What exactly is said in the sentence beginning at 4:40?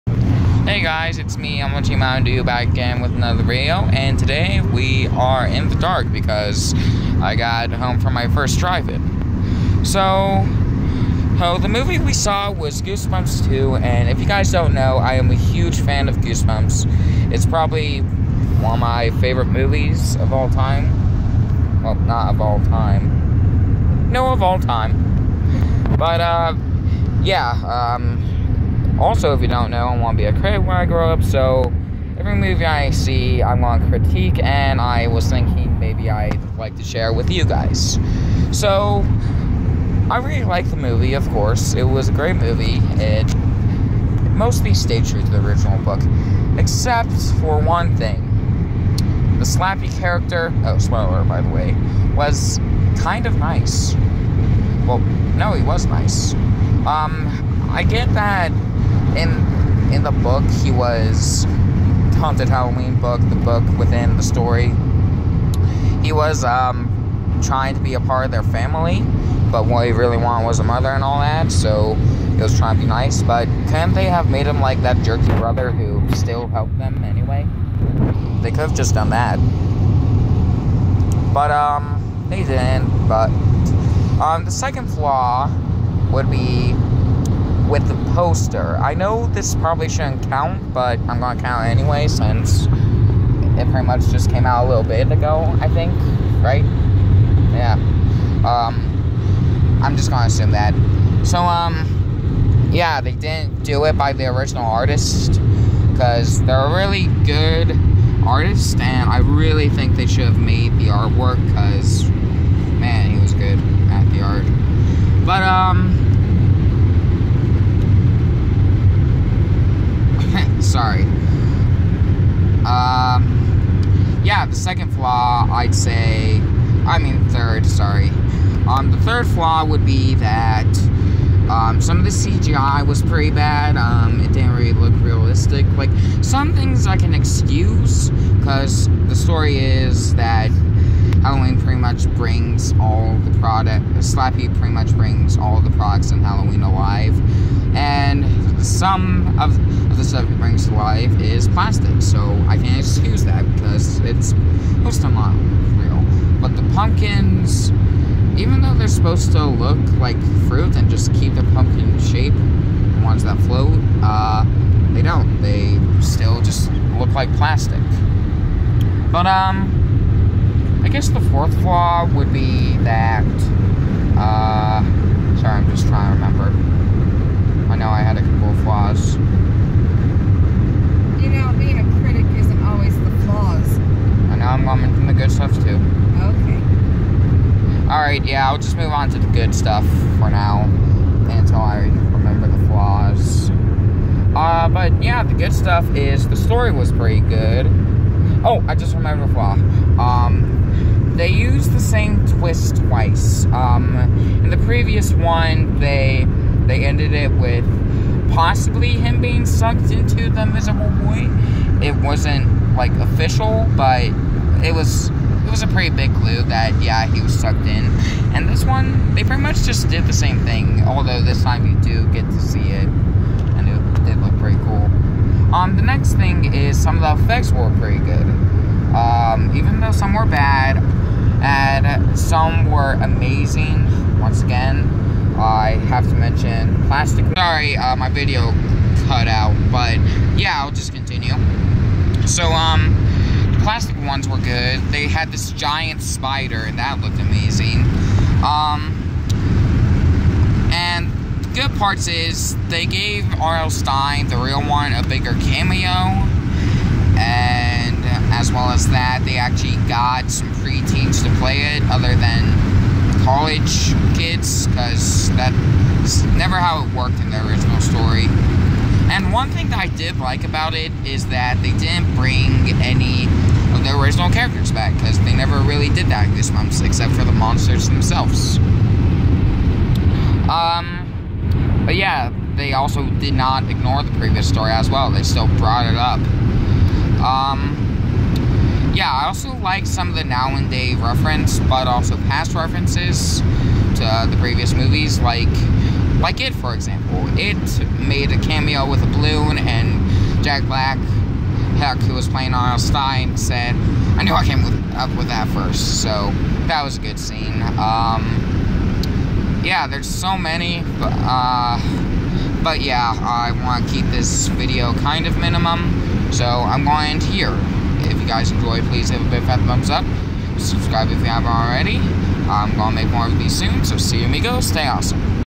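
Um, but yeah, they also did not ignore the previous story as well.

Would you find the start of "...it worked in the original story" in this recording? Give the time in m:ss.
4:26.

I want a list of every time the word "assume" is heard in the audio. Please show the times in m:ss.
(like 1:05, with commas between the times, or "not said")
1:40.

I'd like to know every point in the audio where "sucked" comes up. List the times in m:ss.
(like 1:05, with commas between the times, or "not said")
3:29, 3:37.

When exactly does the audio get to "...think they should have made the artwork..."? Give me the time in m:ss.
1:49.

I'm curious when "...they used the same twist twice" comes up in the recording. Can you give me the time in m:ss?
3:21.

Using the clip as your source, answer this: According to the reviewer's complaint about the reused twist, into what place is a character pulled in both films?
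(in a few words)
the miserable void.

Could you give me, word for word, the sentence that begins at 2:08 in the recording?
Um, the third flaw would be that um, some of the CGI was pretty bad.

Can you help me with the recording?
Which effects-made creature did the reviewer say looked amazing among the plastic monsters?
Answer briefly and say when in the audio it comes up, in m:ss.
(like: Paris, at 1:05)
giant spider, at 4:05.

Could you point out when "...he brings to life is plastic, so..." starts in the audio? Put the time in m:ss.
2:30.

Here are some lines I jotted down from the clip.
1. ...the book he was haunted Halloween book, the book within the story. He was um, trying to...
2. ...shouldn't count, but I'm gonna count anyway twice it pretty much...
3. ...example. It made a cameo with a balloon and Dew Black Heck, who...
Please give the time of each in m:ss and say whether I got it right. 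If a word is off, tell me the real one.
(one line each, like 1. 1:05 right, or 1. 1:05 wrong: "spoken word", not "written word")
1. 1:00 right
2. 1:29 wrong: "since", not "twice"
3. 4:56 wrong: "Jack", not "Dew".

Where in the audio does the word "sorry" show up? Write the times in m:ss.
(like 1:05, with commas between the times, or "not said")
2:07, 2:55, 3:57.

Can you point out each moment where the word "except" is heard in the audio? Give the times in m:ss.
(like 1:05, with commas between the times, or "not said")
0:46, 4:36.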